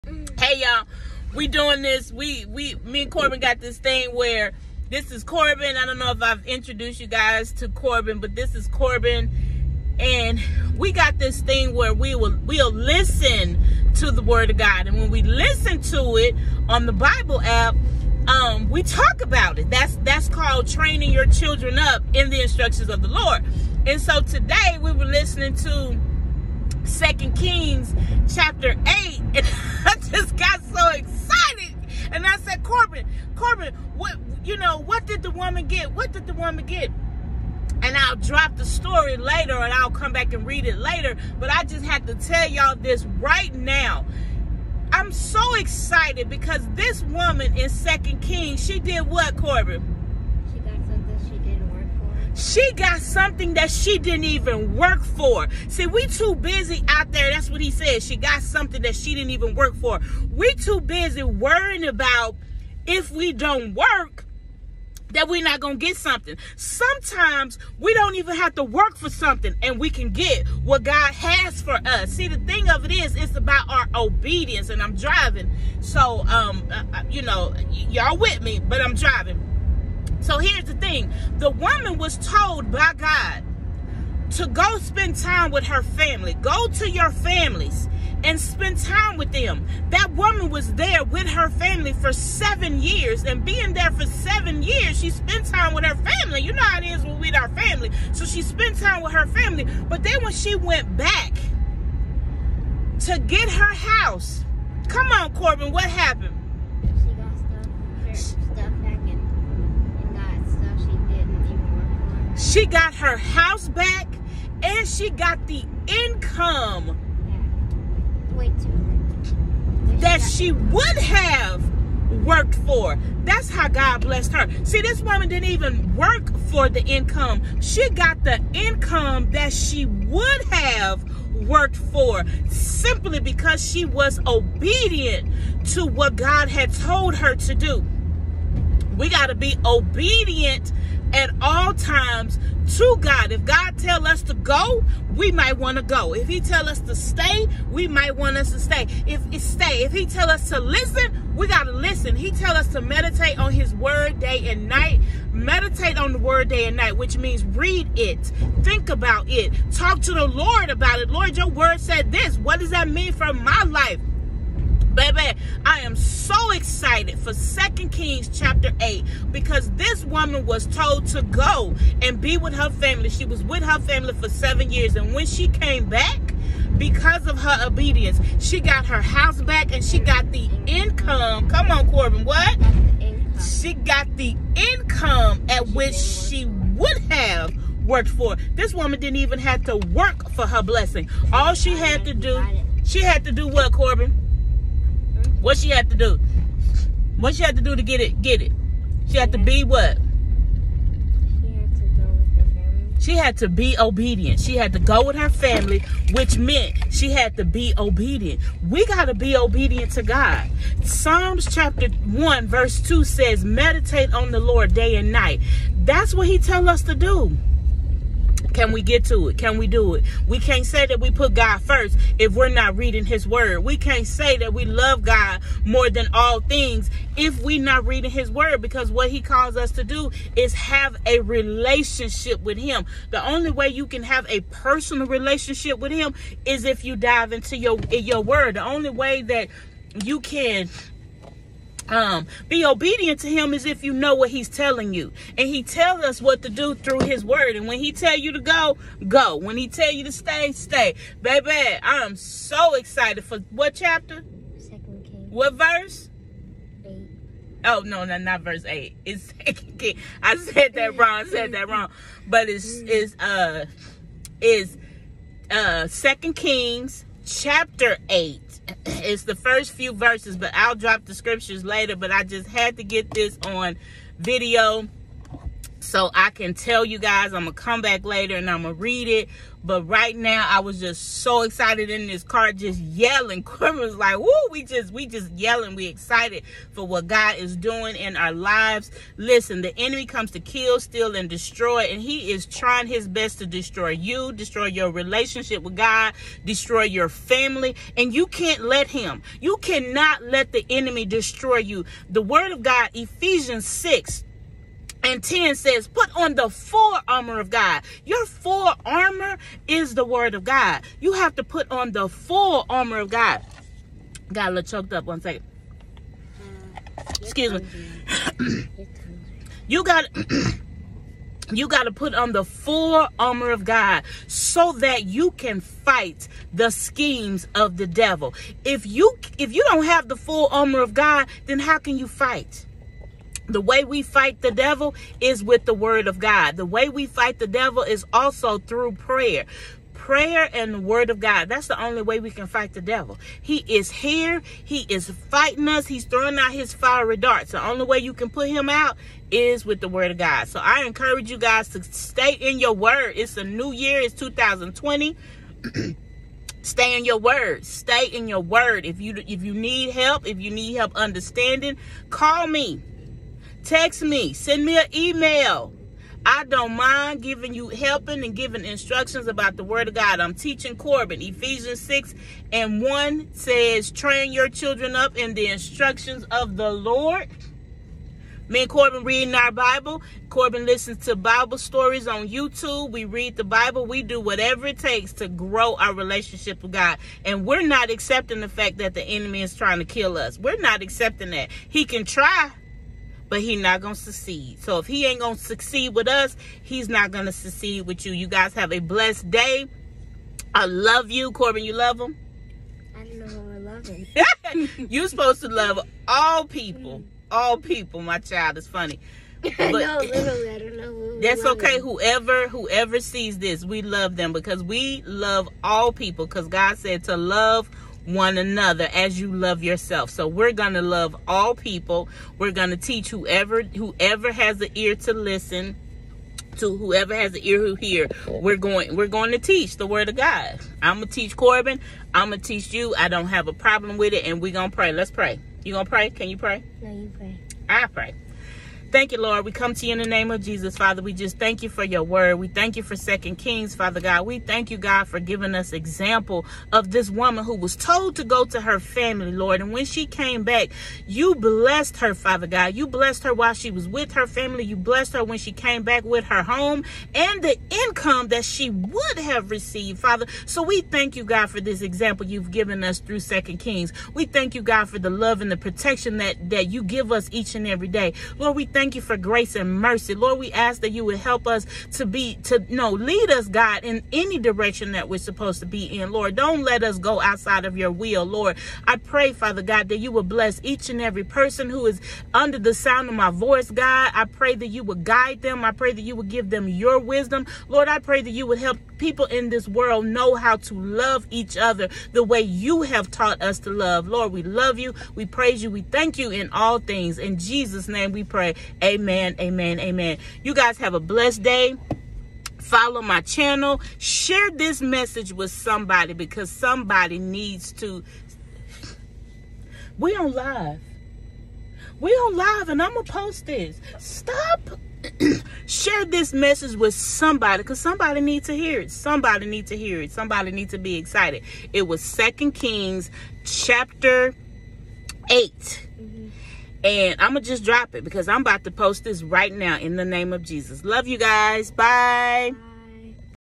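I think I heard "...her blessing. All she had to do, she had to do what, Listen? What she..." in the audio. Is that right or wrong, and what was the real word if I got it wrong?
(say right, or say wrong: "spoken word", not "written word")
wrong: "Corbin", not "Listen".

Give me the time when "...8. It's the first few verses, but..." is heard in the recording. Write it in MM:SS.
04:28.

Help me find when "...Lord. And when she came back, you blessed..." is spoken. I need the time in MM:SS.
07:29.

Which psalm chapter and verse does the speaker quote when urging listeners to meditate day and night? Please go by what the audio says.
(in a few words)
Psalms 1:2.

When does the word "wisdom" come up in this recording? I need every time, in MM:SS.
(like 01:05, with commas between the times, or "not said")
08:06.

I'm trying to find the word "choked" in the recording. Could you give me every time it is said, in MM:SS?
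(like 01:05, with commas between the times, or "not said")
05:14.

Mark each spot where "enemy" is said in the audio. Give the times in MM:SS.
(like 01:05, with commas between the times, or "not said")
04:49, 05:00, 06:29.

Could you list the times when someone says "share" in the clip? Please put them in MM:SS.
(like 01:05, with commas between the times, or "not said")
08:23, 08:35.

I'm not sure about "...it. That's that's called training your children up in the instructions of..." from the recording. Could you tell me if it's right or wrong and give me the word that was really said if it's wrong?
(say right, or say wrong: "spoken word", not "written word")
right.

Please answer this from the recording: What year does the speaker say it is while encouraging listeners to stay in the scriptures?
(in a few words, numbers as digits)
2020.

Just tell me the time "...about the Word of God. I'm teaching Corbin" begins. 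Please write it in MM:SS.
06:09.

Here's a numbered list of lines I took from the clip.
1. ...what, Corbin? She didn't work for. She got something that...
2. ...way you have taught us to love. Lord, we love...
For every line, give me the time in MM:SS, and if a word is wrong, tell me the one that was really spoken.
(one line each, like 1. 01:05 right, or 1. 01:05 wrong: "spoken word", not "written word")
1. 00:49 right
2. 08:12 right.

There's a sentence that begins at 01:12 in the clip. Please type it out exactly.
See, the thing of it is, it's about our obedience.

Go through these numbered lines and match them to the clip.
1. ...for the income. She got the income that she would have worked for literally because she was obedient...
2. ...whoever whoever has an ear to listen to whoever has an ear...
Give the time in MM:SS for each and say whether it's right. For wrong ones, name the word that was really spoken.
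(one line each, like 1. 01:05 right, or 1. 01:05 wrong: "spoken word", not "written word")
1. 02:06 wrong: "simply", not "literally"
2. 07:03 right.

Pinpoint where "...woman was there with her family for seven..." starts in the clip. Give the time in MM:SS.
01:30.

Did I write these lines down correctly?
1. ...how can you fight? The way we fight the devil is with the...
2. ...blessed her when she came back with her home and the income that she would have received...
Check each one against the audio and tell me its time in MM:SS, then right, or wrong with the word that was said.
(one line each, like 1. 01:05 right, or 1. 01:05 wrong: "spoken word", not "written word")
1. 05:31 right
2. 07:34 right.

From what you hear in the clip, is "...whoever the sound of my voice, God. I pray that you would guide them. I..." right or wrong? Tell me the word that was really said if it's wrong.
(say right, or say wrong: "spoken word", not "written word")
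wrong: "under", not "whoever".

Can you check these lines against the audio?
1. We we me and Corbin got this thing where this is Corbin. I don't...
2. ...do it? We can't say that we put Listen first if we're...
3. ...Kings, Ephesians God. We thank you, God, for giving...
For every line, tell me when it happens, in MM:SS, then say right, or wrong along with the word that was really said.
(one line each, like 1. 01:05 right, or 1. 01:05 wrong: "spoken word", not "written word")
1. 00:02 right
2. 03:39 wrong: "God", not "Listen"
3. 07:23 wrong: "Father", not "Ephesians".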